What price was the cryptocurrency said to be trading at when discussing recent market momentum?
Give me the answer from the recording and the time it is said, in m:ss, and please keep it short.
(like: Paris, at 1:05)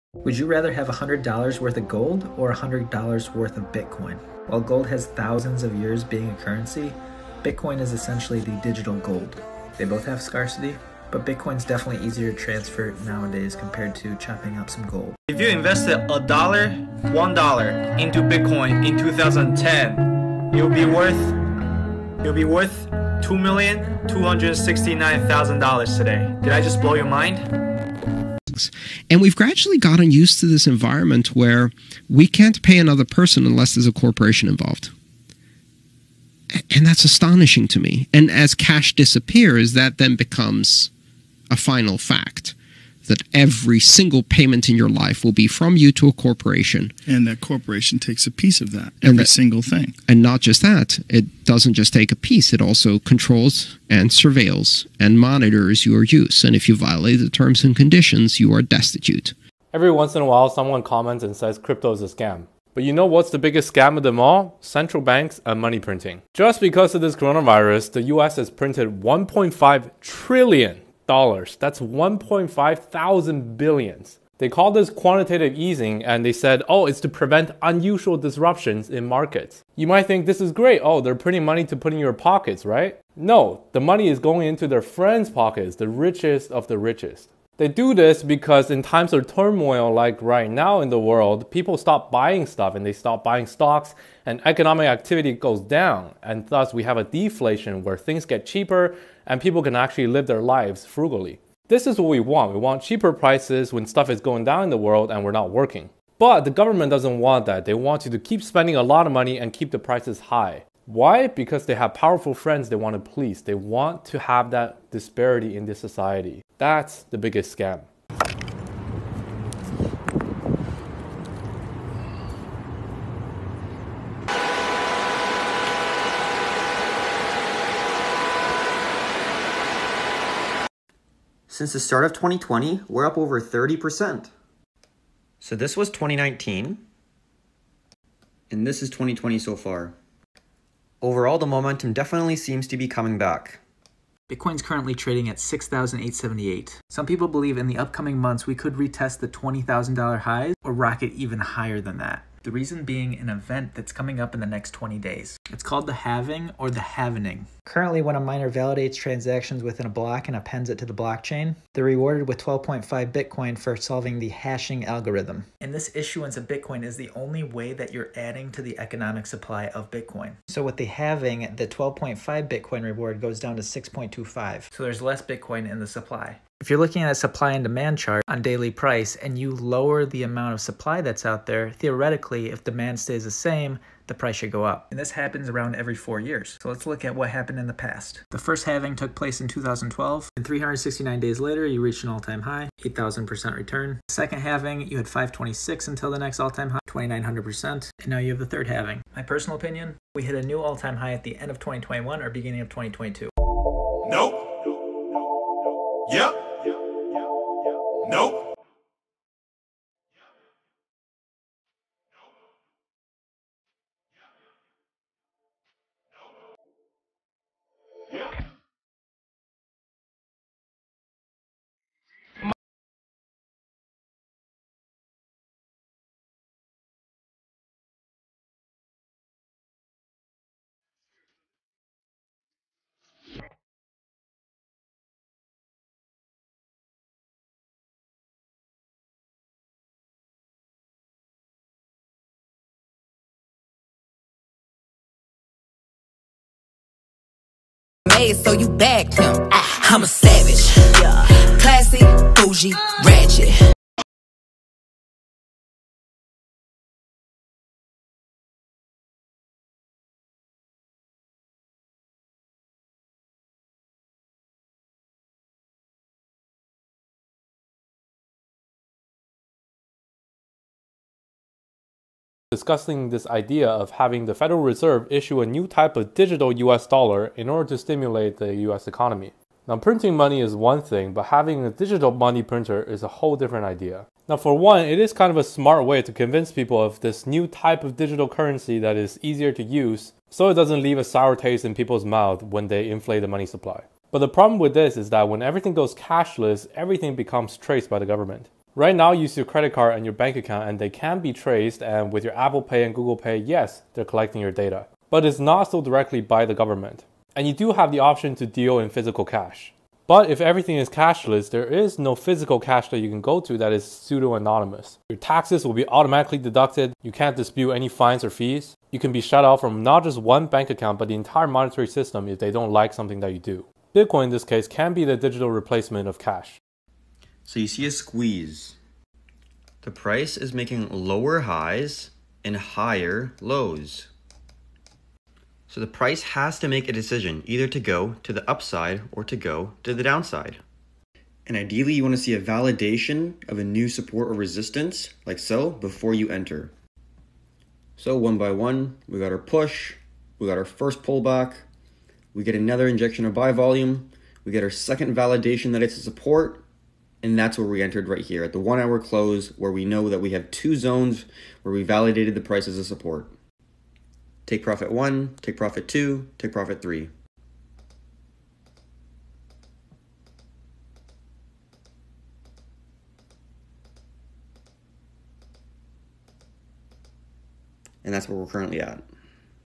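6,878, at 2:25.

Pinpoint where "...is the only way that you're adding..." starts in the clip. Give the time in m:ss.
2:46.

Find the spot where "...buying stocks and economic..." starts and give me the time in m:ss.
1:33.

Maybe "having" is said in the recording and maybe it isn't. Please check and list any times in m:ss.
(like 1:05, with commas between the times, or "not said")
4:33, 4:41.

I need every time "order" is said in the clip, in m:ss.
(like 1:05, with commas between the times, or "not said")
4:37.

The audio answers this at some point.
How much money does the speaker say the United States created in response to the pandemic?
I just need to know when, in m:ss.
1:09.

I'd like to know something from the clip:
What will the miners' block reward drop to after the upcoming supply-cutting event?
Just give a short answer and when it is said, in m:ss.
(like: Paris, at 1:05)
6.25, at 2:53.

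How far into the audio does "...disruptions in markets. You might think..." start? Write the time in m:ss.
1:18.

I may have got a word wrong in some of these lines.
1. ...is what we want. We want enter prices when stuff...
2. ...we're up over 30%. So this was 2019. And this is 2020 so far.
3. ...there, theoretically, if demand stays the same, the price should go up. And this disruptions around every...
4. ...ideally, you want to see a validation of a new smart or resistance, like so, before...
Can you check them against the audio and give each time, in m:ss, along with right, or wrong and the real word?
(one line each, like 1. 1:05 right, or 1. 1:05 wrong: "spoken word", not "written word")
1. 1:41 wrong: "cheaper", not "enter"
2. 2:12 right
3. 3:01 wrong: "happens", not "disruptions"
4. 5:41 wrong: "support", not "smart".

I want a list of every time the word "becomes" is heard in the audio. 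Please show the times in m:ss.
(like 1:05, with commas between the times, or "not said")
0:40, 4:57.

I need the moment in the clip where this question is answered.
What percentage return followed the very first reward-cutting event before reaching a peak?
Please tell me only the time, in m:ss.
3:12.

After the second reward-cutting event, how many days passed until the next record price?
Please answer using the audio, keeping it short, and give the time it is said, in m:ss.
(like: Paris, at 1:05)
526, at 3:15.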